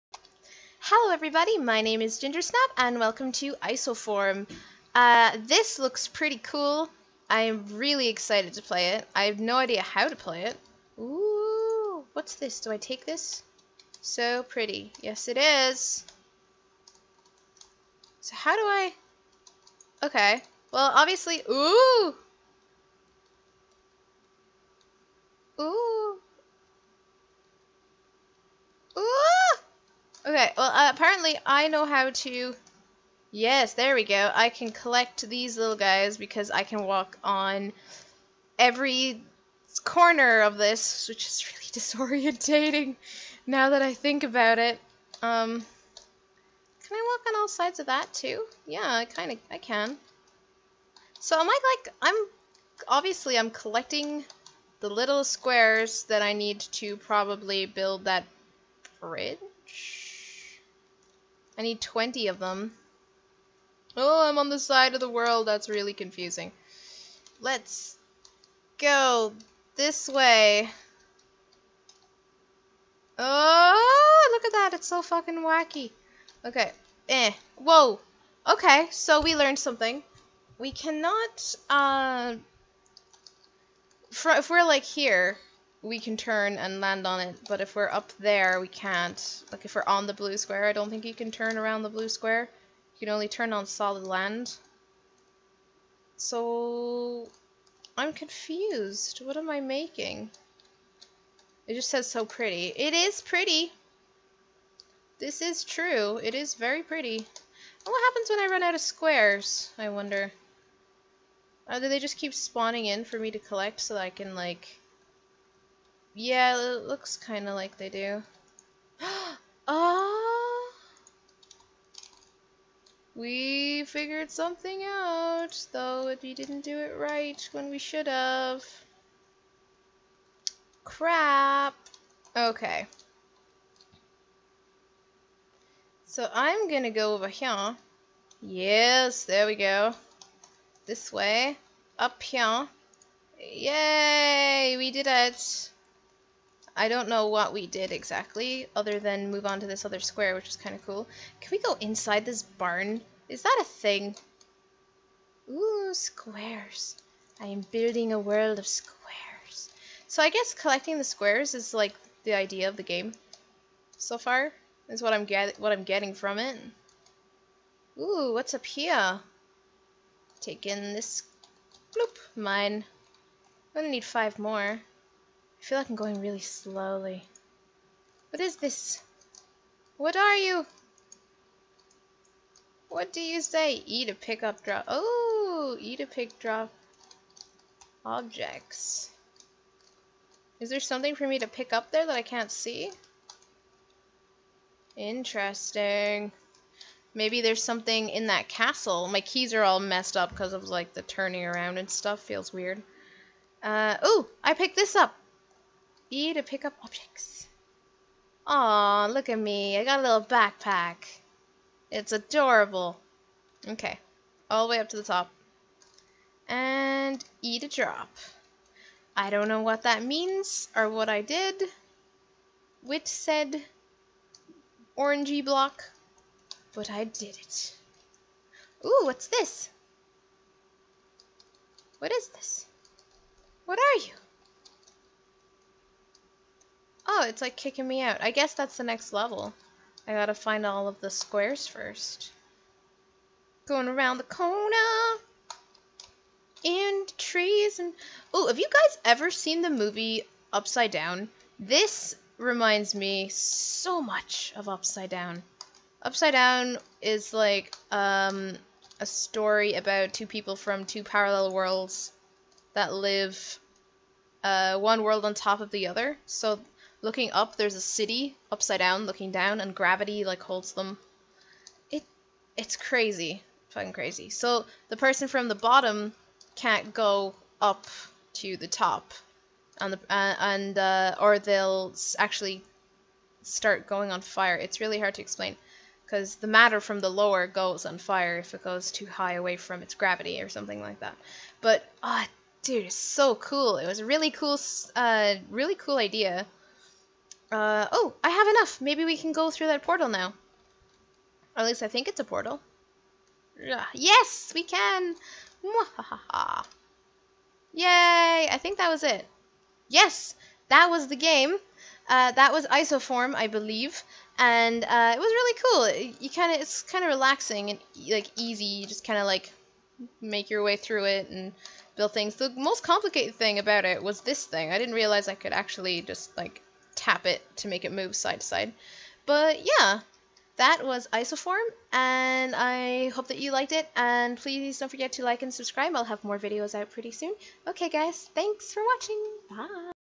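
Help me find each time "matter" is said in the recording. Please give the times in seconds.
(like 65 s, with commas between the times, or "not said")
286 s.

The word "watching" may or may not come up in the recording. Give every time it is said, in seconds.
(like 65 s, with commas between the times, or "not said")
338 s.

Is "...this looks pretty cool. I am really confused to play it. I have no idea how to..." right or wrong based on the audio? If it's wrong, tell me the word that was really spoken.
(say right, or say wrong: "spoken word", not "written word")
wrong: "excited", not "confused".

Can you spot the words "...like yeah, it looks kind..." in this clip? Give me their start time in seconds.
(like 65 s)
114 s.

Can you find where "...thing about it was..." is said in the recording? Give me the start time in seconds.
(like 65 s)
323 s.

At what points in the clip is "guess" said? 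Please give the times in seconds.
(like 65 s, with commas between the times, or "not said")
160 s, 238 s.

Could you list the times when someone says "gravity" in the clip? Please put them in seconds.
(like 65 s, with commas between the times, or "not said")
269 s, 289 s.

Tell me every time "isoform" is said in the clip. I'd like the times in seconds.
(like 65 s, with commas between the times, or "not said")
3 s, 312 s, 331 s.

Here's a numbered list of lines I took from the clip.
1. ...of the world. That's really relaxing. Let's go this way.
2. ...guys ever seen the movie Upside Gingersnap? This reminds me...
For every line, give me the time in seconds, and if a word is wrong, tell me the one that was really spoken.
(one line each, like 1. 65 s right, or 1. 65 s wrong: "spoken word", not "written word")
1. 64 s wrong: "confusing", not "relaxing"
2. 248 s wrong: "Down", not "Gingersnap".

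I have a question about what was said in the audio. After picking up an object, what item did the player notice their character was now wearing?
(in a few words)
backpack.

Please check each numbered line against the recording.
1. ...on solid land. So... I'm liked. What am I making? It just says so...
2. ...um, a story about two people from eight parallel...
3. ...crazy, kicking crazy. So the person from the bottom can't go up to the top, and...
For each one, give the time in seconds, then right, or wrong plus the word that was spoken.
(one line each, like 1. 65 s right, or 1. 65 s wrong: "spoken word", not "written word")
1. 93 s wrong: "confused", not "liked"
2. 257 s wrong: "two", not "eight"
3. 272 s wrong: "fucking", not "kicking".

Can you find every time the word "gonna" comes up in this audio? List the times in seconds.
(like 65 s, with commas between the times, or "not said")
136 s, 173 s.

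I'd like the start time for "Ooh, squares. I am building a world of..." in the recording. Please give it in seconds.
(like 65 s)
155 s.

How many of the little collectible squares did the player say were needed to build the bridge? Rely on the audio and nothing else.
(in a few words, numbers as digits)
20.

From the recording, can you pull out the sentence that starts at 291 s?
But ah, oh, dude, it's so cool.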